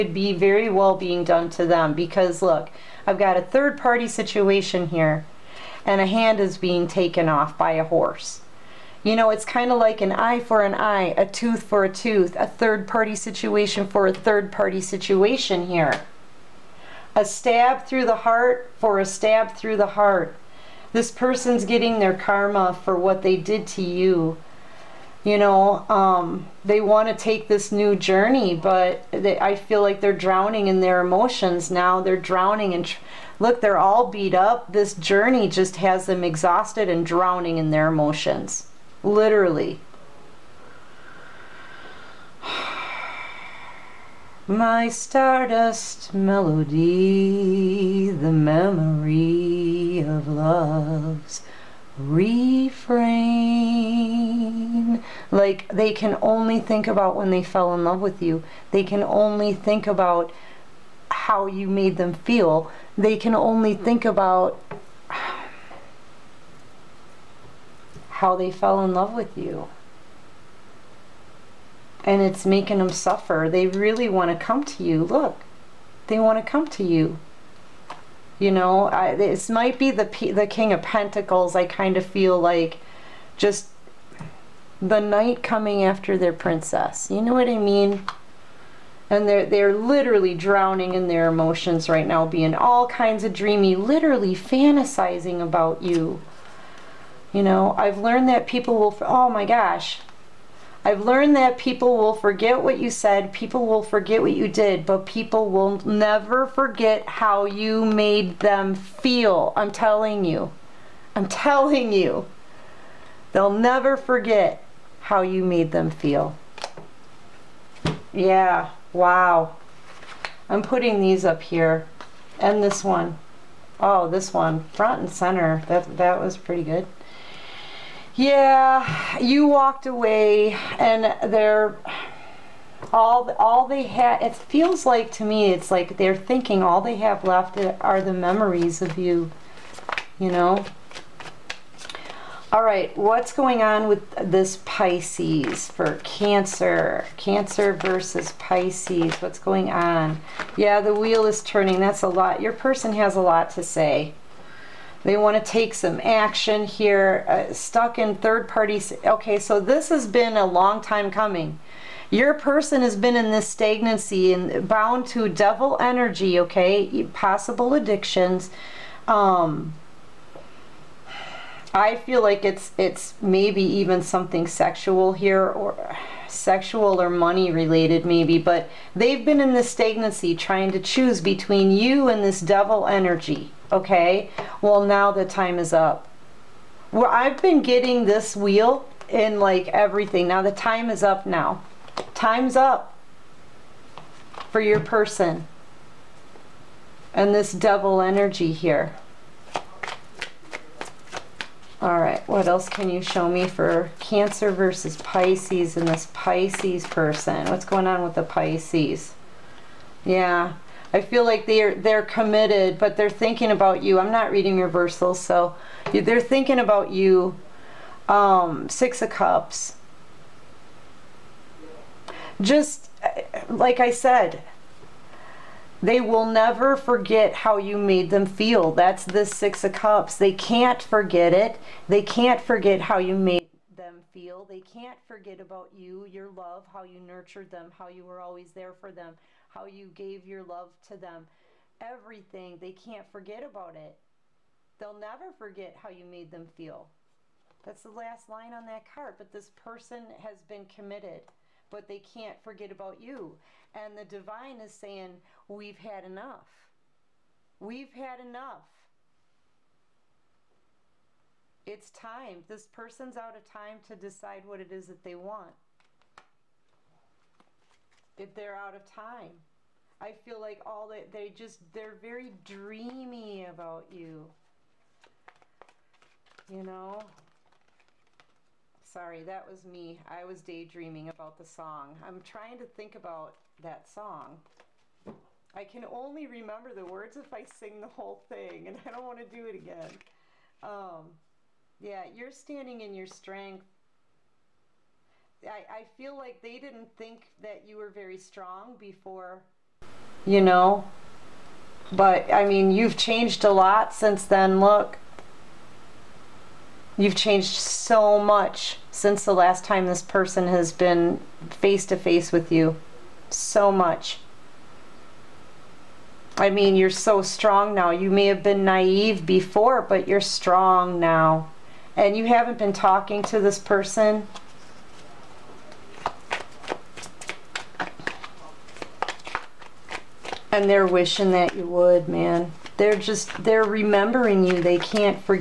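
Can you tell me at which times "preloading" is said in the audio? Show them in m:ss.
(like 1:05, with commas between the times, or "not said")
not said.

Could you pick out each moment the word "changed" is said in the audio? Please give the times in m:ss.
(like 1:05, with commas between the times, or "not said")
5:02, 5:07.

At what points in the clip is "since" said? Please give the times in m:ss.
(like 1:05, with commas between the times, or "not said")
5:03, 5:08.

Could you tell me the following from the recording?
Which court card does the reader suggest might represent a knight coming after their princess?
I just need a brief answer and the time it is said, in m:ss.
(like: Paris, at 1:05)
King of Pentacles, at 1:20.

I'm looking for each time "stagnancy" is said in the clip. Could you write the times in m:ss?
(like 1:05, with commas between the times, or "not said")
2:43, 2:59.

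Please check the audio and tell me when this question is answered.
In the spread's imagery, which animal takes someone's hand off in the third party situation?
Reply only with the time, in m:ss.
0:07.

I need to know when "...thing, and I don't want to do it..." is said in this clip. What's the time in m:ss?
4:48.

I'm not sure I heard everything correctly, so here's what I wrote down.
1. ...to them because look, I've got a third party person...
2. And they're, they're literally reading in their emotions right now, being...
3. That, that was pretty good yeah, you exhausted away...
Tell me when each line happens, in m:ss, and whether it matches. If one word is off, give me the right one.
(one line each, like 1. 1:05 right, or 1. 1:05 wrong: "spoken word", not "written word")
1. 0:01 wrong: "situation", not "person"
2. 1:29 wrong: "drowning", not "reading"
3. 2:05 wrong: "walked", not "exhausted".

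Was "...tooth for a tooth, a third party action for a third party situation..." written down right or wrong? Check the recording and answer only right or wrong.
wrong.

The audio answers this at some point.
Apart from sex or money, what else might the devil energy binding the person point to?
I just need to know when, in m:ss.
2:47.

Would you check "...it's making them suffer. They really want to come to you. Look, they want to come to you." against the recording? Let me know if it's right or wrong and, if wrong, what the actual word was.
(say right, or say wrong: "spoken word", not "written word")
right.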